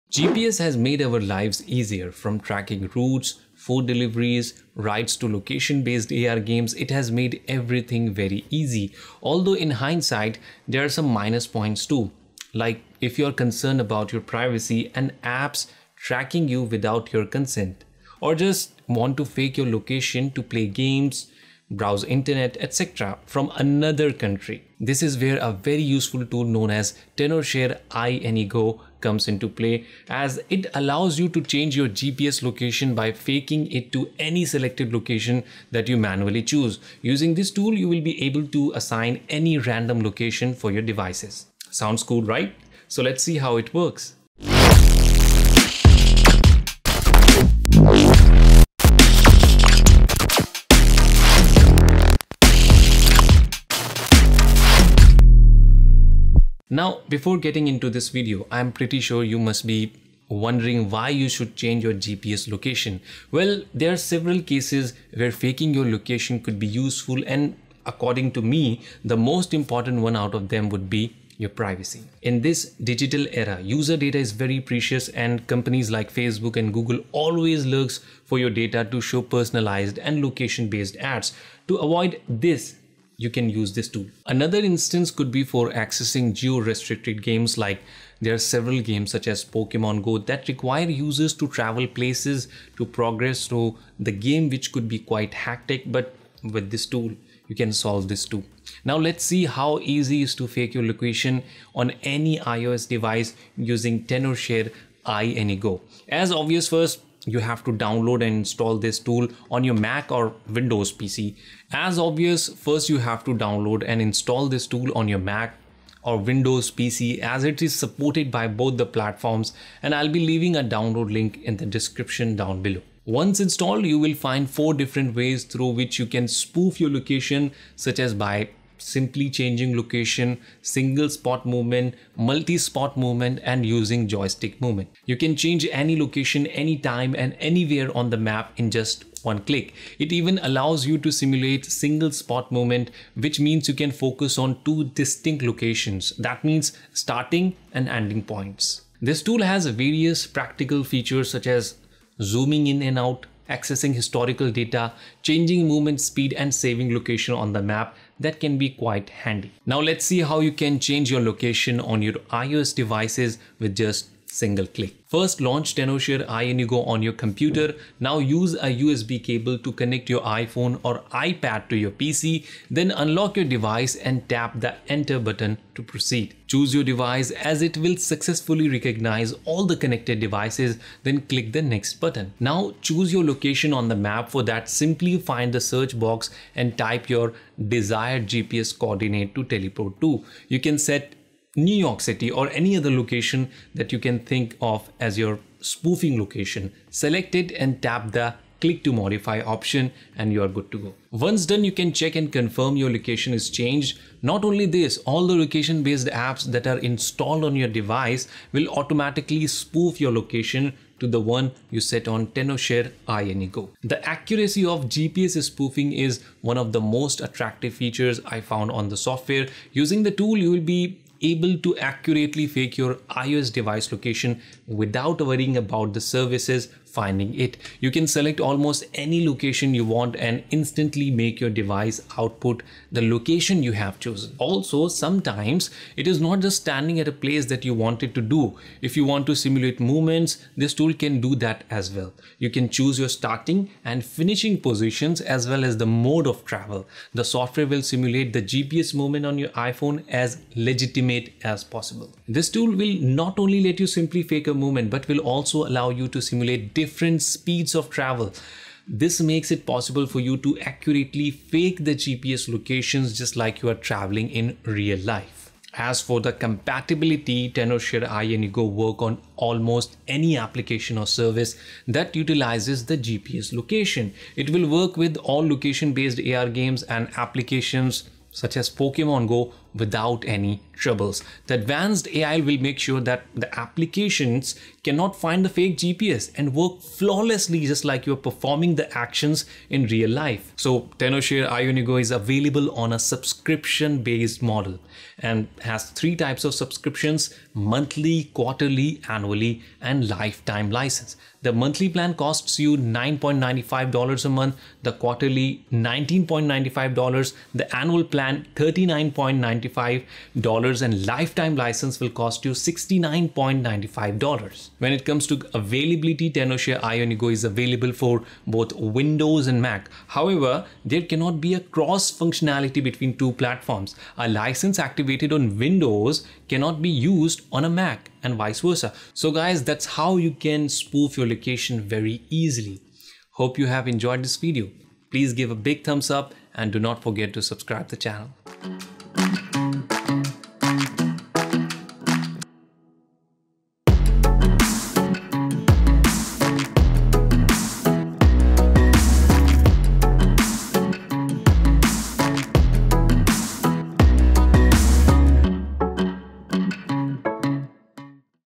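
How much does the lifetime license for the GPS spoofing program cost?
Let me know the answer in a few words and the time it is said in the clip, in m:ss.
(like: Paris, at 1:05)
$69.95, at 5:12.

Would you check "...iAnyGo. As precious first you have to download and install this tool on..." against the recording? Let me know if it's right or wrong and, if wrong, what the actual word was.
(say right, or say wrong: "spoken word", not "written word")
wrong: "obvious", not "precious".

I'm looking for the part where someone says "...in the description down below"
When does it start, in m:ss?
2:01.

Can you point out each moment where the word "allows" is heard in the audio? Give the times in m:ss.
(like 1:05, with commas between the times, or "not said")
0:30, 2:20, 4:15.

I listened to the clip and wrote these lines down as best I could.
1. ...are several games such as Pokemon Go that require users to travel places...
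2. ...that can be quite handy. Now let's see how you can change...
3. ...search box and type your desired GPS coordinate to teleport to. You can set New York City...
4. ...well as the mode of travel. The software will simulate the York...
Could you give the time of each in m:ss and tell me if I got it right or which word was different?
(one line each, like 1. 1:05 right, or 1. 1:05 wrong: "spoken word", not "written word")
1. 1:28 right
2. 2:38 right
3. 3:05 right
4. 4:05 wrong: "GPS", not "York".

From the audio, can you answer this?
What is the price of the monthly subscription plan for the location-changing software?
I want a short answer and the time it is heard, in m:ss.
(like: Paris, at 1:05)
$9.95, at 5:02.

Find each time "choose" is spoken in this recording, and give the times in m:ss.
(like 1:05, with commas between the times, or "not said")
0:36, 2:56, 3:02, 4:02.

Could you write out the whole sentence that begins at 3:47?
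You can select almost any location you want and instantly make your device output the location you have chosen.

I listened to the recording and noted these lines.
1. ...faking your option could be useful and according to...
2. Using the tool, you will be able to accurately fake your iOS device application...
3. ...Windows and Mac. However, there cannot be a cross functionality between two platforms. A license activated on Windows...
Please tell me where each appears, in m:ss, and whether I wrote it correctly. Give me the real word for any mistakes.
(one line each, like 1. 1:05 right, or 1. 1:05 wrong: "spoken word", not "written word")
1. 1:05 wrong: "location", not "option"
2. 3:39 wrong: "location", not "application"
3. 5:18 right.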